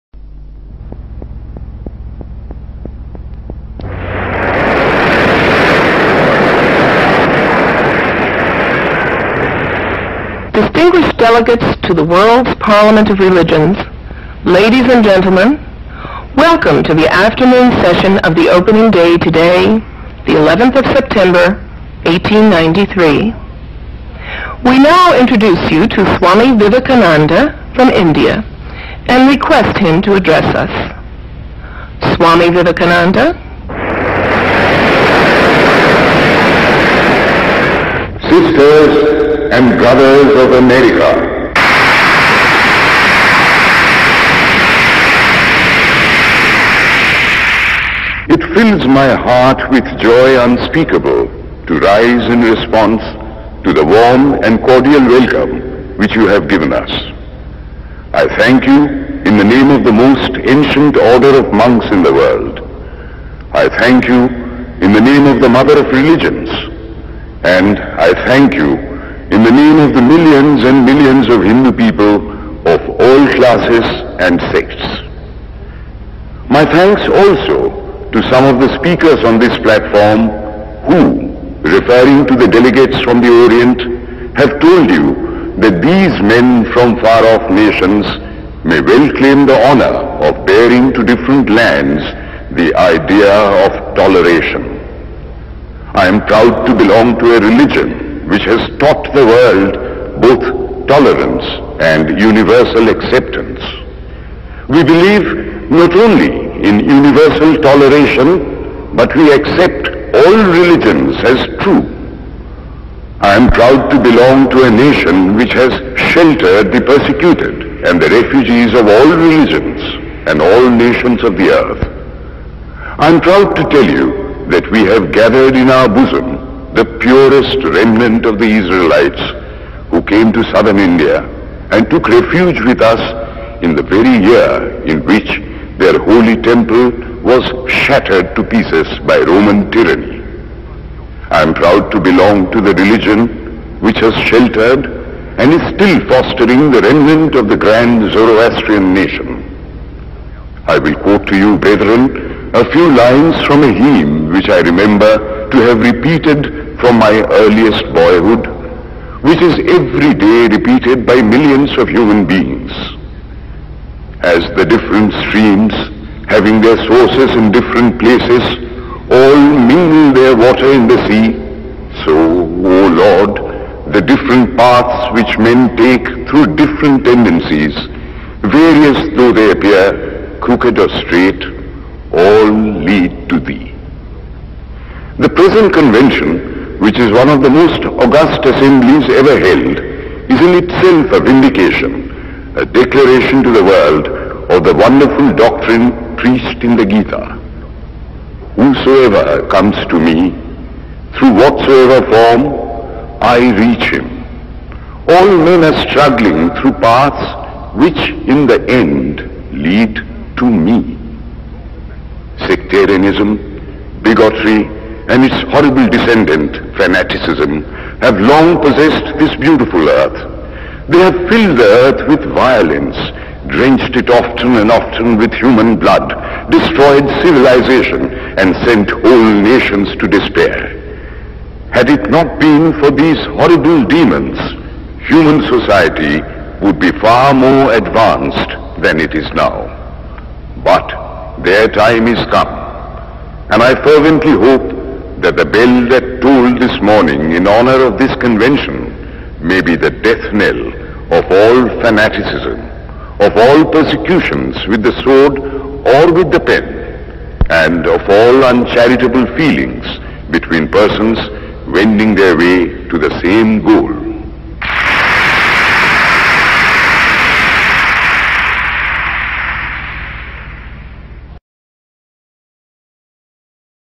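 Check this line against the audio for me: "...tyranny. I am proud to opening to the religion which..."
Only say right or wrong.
wrong.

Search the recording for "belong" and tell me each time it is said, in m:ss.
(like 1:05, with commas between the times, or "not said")
1:36, 1:54, 2:21.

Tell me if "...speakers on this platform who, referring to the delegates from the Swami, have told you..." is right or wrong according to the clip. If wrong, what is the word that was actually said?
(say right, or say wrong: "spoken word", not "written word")
wrong: "Orient", not "Swami".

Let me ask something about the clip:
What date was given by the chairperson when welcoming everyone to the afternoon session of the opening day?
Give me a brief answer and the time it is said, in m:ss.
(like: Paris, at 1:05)
11th of September, 1893, at 0:20.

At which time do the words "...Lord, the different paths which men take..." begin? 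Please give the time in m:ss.
2:53.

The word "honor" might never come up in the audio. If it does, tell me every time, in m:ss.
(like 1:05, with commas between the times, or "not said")
1:29, 4:07.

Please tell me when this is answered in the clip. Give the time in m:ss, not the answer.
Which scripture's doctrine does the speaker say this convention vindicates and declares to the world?
3:16.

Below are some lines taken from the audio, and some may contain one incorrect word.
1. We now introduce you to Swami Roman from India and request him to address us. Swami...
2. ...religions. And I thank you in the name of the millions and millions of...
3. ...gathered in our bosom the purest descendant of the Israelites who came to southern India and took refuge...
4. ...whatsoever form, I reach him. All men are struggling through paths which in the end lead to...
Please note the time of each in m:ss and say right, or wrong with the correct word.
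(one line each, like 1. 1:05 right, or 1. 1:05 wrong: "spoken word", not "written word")
1. 0:24 wrong: "Vivekananda", not "Roman"
2. 1:05 right
3. 2:05 wrong: "remnant", not "descendant"
4. 3:21 right.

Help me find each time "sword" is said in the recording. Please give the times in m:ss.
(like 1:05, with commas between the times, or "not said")
4:15.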